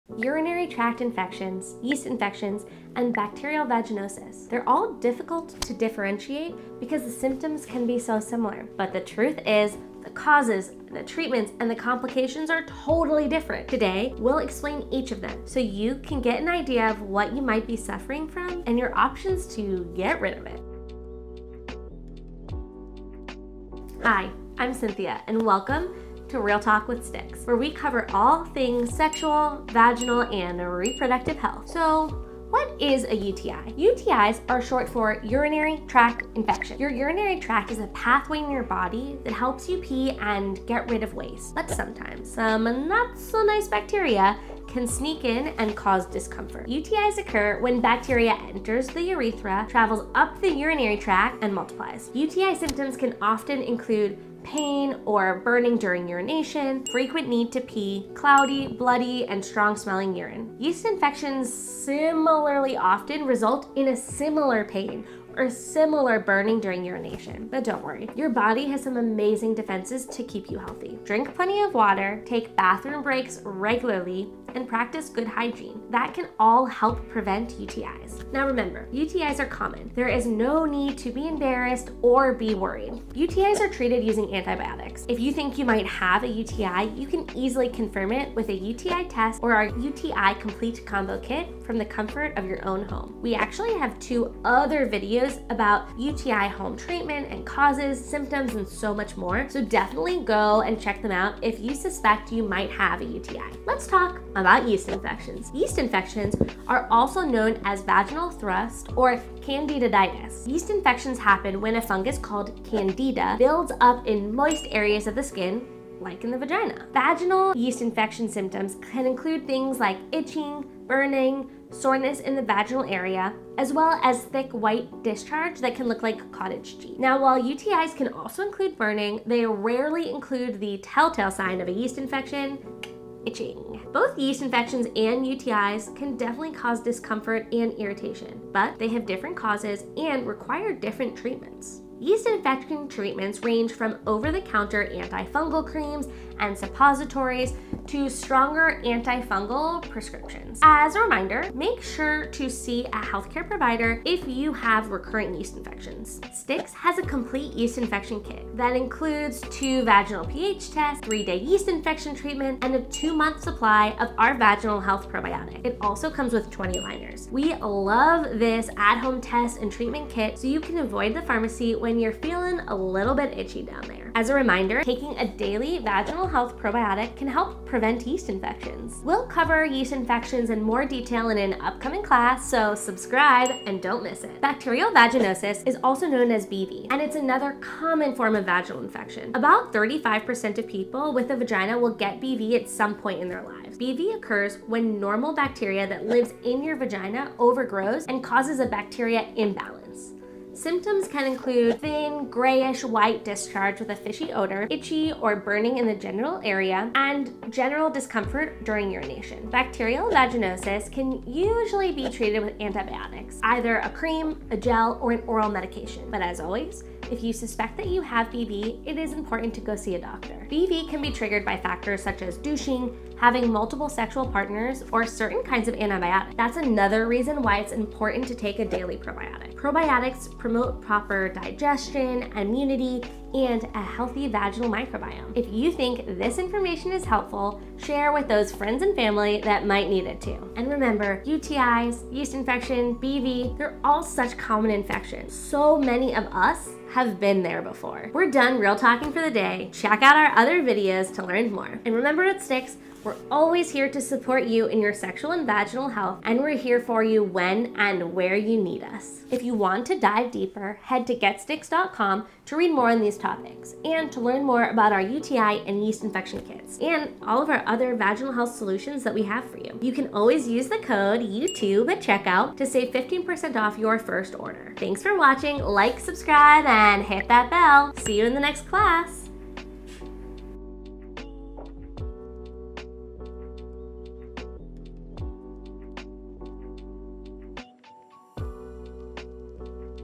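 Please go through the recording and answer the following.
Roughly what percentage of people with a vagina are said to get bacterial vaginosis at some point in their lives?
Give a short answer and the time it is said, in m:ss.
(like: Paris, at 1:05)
35%, at 3:09.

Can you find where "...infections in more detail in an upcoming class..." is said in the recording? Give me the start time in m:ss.
2:59.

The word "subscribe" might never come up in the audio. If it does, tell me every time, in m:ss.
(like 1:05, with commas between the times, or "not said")
3:02, 4:35.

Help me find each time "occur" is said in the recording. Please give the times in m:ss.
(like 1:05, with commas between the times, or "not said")
0:47, 3:14.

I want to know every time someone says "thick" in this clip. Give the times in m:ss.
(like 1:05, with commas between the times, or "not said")
2:04.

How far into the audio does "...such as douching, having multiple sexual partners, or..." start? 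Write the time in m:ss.
3:42.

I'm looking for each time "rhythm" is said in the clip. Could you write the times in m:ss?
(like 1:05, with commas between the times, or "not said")
not said.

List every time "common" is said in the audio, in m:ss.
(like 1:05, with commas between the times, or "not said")
1:19, 3:07, 4:04.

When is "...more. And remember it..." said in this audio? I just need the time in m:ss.
4:11.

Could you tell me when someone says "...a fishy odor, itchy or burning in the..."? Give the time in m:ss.
3:23.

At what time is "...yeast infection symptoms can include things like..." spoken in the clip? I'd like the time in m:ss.
1:57.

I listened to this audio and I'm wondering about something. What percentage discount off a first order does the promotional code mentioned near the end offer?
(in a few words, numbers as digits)
15%.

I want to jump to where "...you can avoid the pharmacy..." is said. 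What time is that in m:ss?
2:50.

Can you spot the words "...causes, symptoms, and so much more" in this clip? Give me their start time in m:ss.
1:37.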